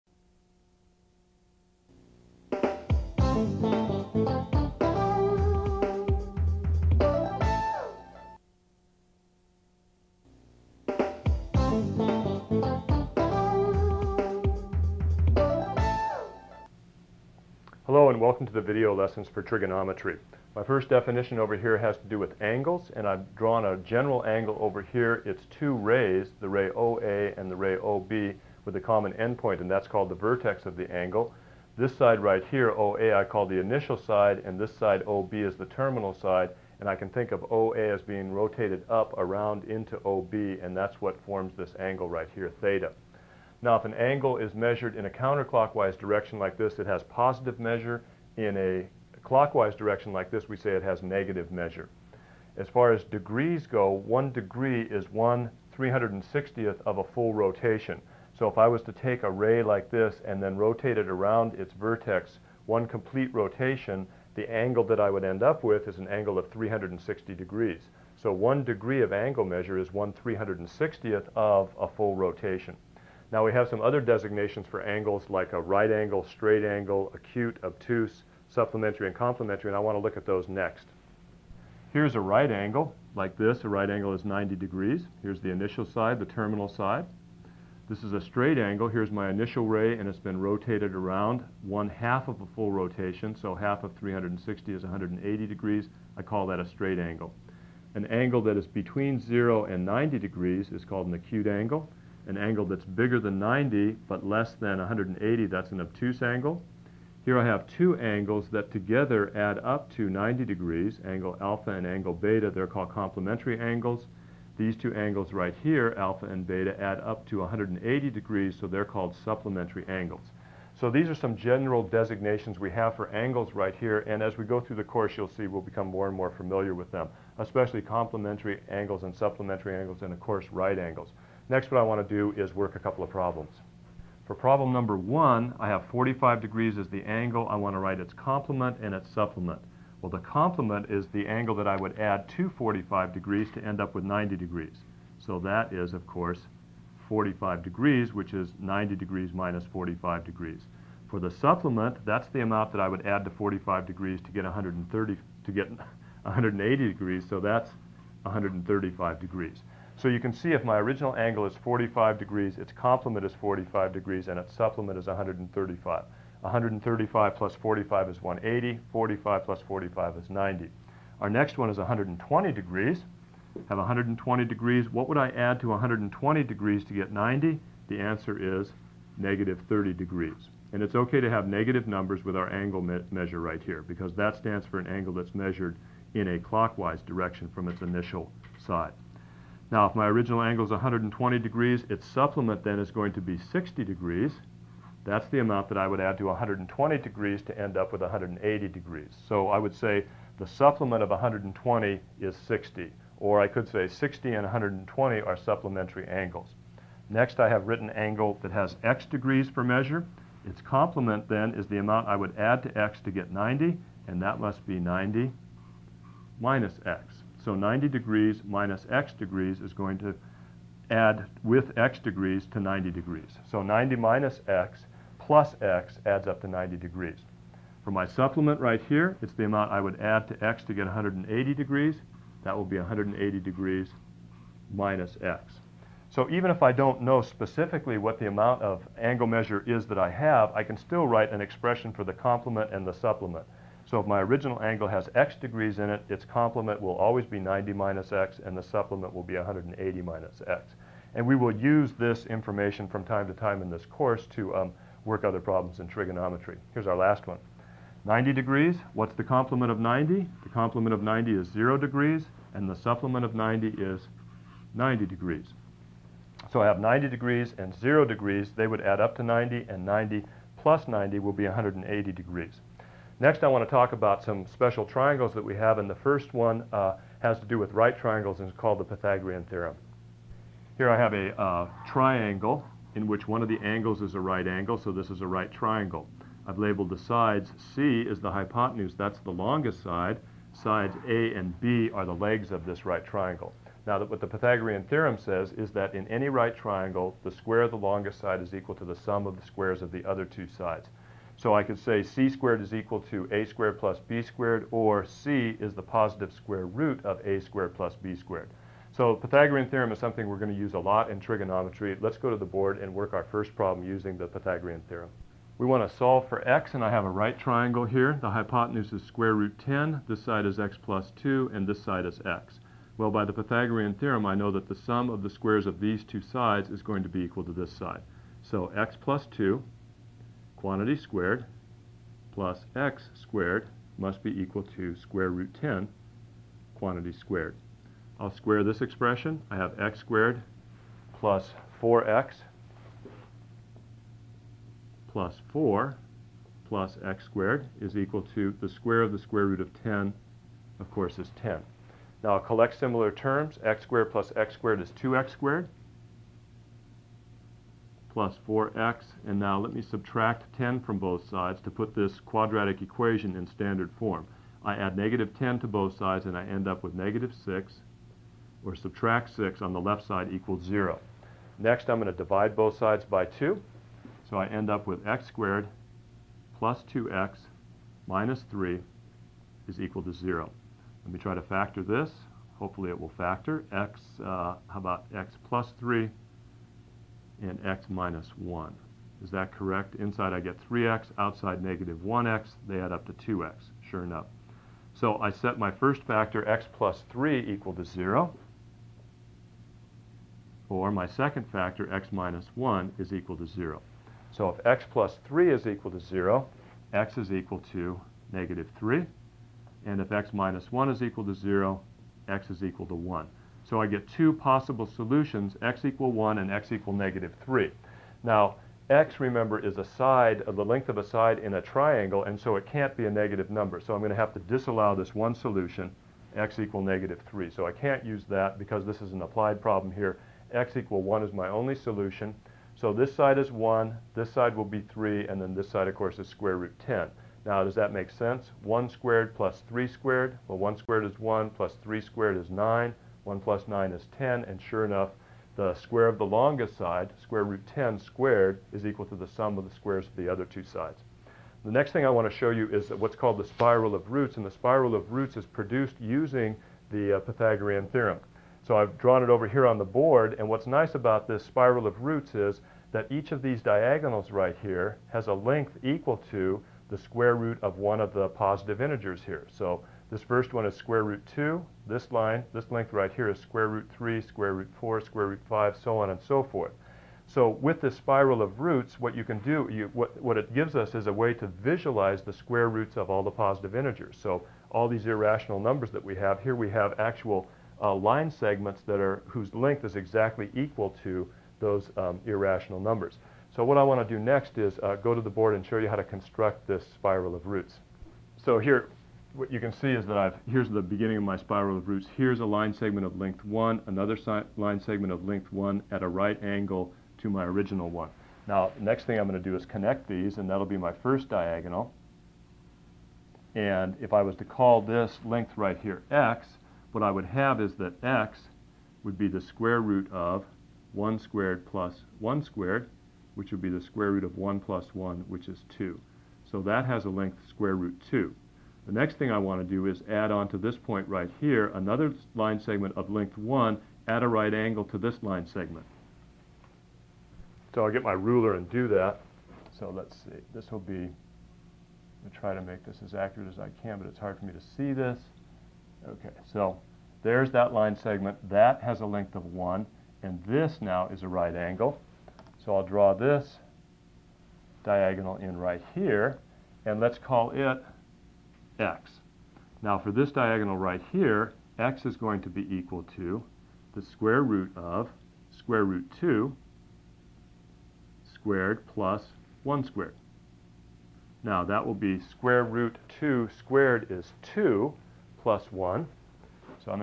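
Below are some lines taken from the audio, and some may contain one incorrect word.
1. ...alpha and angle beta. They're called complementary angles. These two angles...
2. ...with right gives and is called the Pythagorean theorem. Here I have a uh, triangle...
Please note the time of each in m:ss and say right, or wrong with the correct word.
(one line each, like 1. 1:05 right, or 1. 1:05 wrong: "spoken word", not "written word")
1. 1:51 right
2. 4:37 wrong: "triangles", not "gives".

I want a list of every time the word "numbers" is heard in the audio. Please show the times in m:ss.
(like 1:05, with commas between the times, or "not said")
2:14, 3:01, 7:03, 8:05, 8:12.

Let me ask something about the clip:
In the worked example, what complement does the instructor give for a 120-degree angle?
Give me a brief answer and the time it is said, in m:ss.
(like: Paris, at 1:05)
-30 degrees, at 2:59.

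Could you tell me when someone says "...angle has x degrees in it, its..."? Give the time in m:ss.
4:04.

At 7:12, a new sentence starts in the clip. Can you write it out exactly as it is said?
So this side is 1, this side will be 3, and then this side, of course, is square root 10.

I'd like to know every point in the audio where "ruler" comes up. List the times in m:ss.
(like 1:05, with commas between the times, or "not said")
8:58.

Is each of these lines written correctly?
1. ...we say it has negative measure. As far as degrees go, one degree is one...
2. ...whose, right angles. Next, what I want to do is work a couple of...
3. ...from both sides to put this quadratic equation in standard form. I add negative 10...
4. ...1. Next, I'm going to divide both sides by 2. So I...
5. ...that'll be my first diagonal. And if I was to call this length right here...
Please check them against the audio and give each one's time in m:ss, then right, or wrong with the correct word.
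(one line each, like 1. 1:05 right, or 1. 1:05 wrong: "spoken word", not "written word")
1. 0:50 right
2. 2:10 wrong: "course", not "whose"
3. 6:00 right
4. 6:10 wrong: "0", not "1"
5. 8:30 right.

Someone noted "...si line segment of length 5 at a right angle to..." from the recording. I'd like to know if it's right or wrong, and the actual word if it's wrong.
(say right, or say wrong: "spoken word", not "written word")
wrong: "1", not "5".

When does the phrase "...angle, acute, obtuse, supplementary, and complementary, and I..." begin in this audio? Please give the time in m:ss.
1:16.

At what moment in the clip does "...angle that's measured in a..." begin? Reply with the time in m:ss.
3:04.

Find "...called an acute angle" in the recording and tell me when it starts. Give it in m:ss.
1:40.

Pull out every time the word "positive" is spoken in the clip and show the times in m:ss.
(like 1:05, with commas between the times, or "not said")
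0:47, 5:05, 7:48, 8:03.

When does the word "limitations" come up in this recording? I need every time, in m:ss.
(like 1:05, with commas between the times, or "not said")
not said.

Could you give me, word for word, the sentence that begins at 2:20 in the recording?
Well, the complement is the angle that I would add to 45 degrees to end up with 90 degrees.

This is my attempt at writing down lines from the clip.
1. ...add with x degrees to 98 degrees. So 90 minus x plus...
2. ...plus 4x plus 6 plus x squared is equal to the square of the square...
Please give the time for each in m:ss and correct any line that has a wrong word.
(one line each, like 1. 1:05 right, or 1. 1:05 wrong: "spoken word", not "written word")
1. 3:40 wrong: "90", not "98"
2. 5:41 wrong: "4", not "6".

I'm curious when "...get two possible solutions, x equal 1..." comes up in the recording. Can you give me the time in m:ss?
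6:53.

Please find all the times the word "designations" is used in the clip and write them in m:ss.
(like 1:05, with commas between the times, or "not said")
1:14, 2:01.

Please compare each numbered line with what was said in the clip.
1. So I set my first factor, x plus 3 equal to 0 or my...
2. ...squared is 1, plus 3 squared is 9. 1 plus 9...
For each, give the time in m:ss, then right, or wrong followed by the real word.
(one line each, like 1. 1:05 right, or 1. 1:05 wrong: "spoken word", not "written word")
1. 6:34 right
2. 7:20 right.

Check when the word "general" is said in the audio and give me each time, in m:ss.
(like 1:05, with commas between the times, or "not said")
0:23, 2:01.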